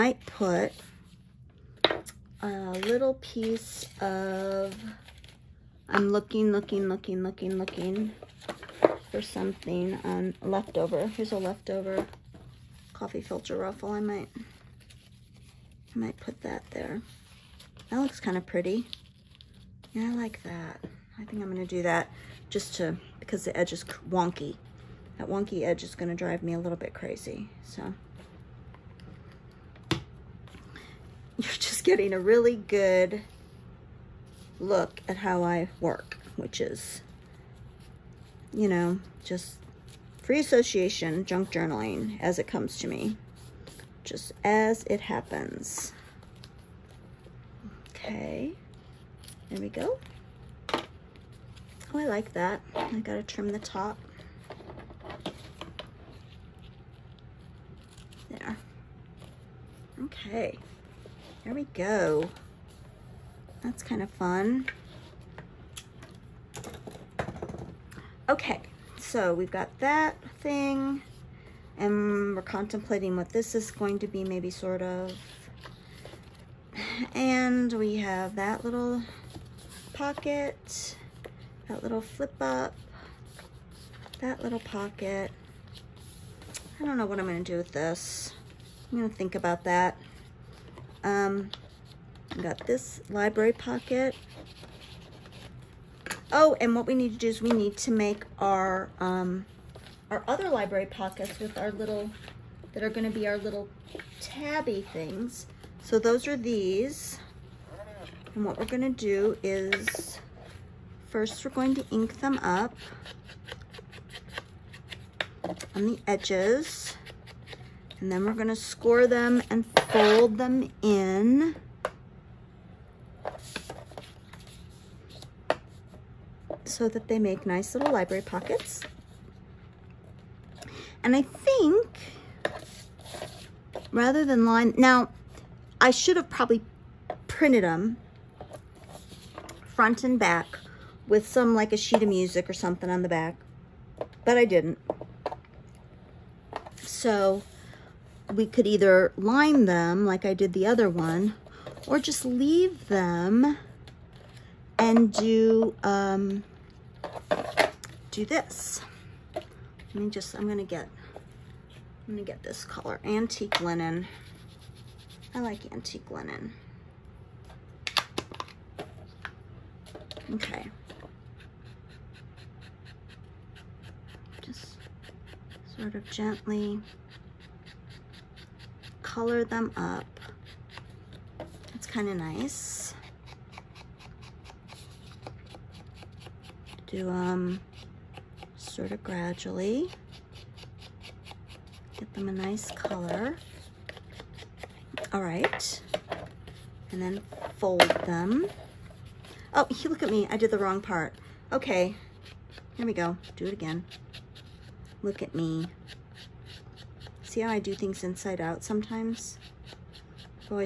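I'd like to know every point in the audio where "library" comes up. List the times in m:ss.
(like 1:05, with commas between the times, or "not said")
1:33, 1:40, 2:07.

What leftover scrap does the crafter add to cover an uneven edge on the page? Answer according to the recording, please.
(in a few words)
Coffee filter ruffle.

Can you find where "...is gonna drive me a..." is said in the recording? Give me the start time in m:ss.
0:25.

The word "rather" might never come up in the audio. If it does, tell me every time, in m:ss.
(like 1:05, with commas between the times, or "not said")
2:13.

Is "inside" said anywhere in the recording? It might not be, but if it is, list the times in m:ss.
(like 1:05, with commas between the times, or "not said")
3:28.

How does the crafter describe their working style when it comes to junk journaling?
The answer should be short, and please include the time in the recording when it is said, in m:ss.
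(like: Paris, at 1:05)
Free association, at 0:40.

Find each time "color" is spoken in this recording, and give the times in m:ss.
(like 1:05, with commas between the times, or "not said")
2:42, 2:59, 3:12.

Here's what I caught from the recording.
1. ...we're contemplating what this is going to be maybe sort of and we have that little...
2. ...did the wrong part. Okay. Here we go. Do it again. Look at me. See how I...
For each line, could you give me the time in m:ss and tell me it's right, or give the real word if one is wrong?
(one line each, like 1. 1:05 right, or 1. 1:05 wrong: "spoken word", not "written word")
1. 1:12 right
2. 3:20 right.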